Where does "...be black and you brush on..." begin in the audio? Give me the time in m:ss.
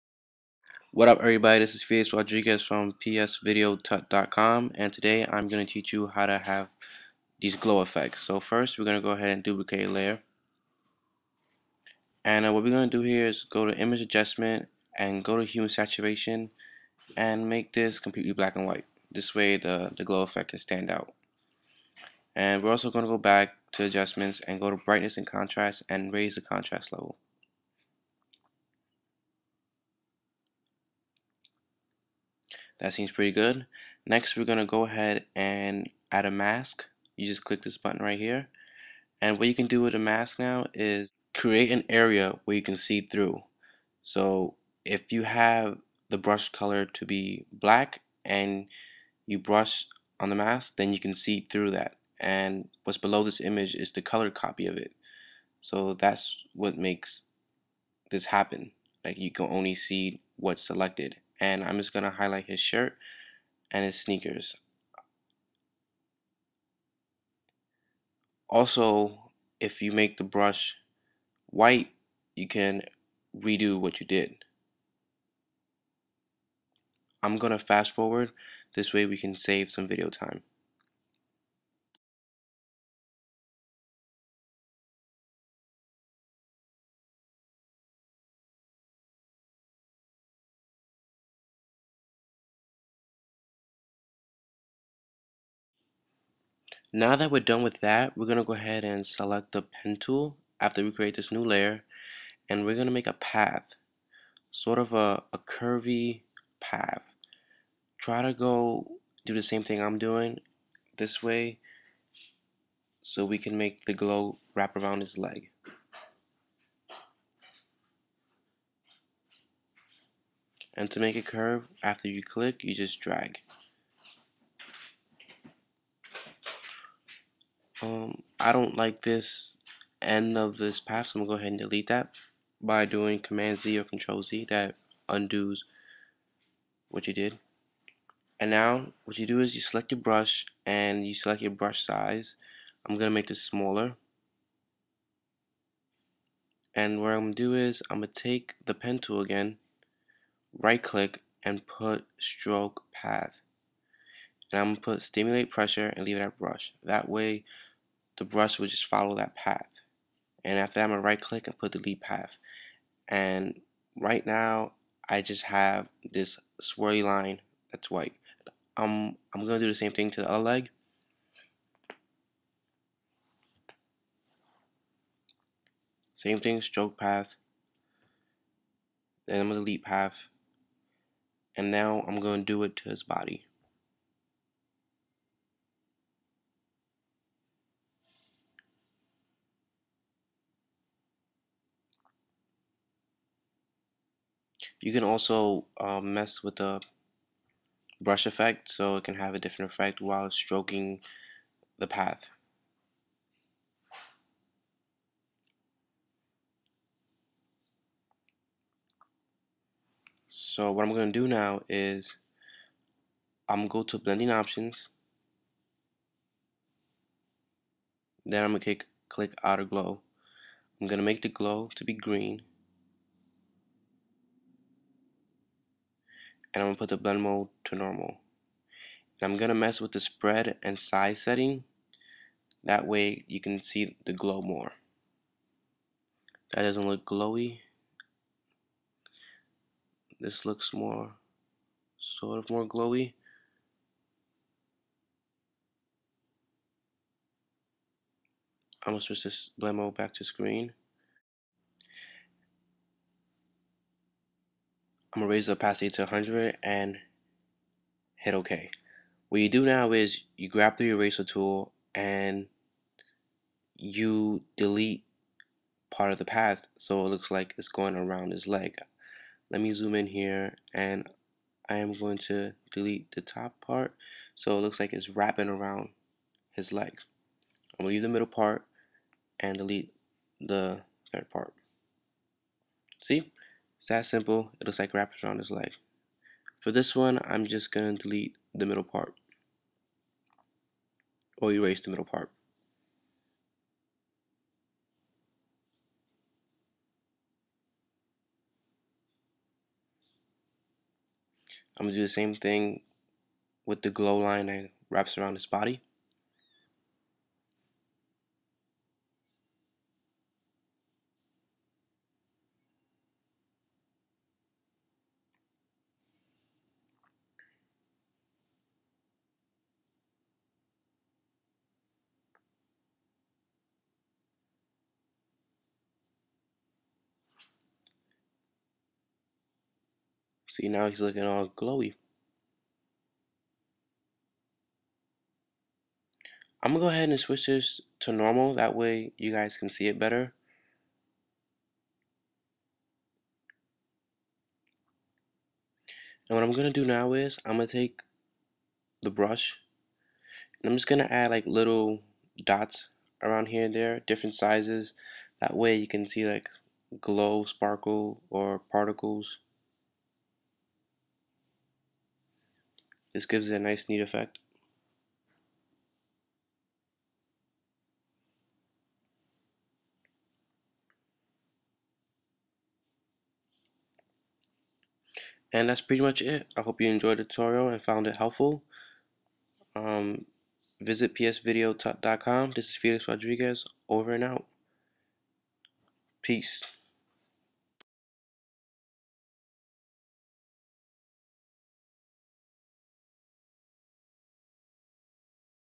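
0:47.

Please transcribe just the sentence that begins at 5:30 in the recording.
See, now he's looking all glowy.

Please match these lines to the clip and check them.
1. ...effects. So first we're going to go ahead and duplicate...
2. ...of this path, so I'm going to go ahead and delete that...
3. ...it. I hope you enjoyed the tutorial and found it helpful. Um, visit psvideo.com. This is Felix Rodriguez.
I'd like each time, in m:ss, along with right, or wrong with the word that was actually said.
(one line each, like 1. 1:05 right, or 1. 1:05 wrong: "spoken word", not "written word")
1. 0:07 right
2. 2:10 right
3. 6:16 right.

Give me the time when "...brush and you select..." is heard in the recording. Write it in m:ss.
2:20.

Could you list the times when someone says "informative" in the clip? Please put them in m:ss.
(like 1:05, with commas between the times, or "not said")
not said.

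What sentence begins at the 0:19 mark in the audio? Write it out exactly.
This way the, the glow effect can stand out.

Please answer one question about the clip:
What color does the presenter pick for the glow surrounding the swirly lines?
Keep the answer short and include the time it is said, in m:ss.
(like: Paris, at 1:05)
Green, at 3:41.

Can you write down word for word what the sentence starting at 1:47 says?
Try to go do the same thing I'm doing this way so we can make the glow wrap around his leg.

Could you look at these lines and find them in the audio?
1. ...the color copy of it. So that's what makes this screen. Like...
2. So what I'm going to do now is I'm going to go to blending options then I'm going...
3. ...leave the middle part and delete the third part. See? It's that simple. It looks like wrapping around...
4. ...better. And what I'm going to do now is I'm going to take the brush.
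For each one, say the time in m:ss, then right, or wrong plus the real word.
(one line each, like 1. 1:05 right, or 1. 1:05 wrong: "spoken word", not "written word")
1. 0:53 wrong: "happen", not "screen"
2. 3:30 right
3. 4:37 right
4. 5:39 right.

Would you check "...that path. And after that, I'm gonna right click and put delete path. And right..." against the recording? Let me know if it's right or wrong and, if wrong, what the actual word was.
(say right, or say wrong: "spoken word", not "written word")
right.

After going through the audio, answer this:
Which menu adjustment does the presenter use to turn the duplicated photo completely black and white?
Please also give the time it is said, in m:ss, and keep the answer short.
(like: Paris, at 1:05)
Hue and saturation, at 0:15.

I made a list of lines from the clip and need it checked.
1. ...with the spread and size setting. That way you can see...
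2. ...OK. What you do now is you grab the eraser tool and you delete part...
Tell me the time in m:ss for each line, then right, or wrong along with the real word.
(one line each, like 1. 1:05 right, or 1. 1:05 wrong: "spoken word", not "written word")
1. 3:49 right
2. 4:18 right.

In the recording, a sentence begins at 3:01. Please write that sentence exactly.
And now I'm gonna do it to his body.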